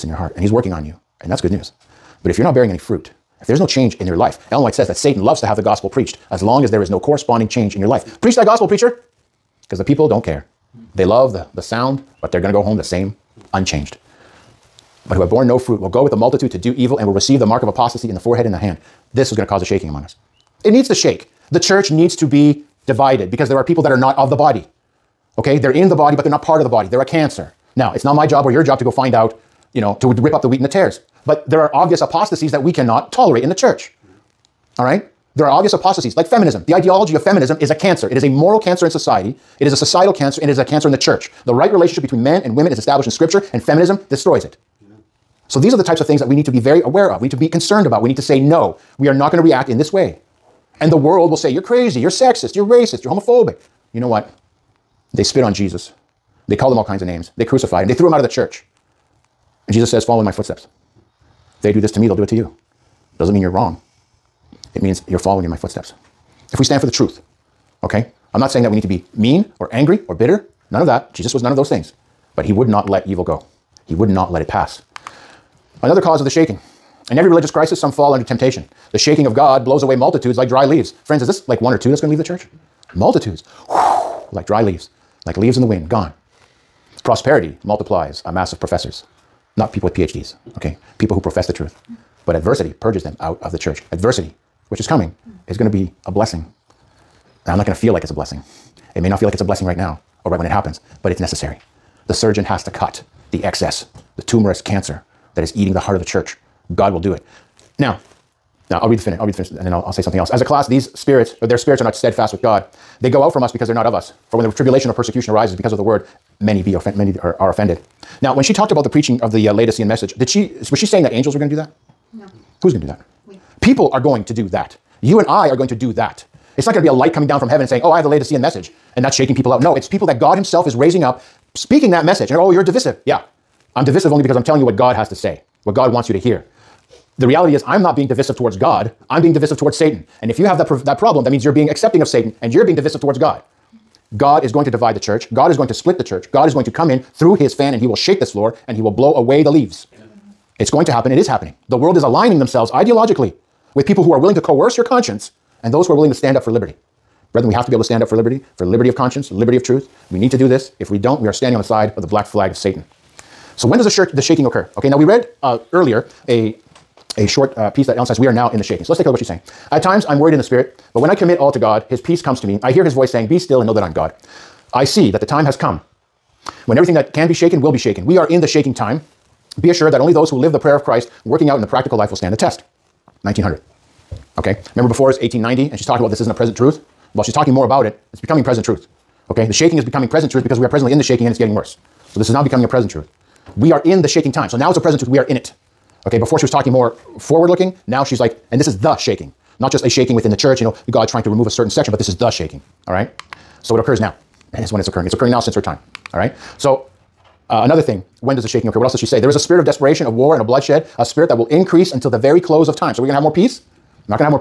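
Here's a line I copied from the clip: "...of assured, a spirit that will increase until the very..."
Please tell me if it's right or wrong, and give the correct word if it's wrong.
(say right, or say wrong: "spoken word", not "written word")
wrong: "bloodshed", not "assured".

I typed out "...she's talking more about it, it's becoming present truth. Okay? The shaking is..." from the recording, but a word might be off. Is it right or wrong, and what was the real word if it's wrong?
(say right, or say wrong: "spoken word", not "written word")
right.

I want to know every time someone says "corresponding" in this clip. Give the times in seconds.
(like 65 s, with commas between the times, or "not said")
6 s.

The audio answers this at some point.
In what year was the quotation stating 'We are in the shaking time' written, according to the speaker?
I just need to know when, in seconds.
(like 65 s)
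183 s.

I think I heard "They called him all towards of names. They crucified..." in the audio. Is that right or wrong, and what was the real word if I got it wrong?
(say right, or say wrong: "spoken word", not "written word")
wrong: "kinds", not "towards".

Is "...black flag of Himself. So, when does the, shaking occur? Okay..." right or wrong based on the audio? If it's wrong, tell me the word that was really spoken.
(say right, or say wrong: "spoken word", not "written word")
wrong: "Satan", not "Himself".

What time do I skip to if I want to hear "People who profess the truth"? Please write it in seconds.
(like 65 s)
90 s.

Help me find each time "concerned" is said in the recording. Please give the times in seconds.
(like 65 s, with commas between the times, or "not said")
47 s.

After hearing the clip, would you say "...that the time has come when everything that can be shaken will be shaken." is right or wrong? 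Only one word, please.
right.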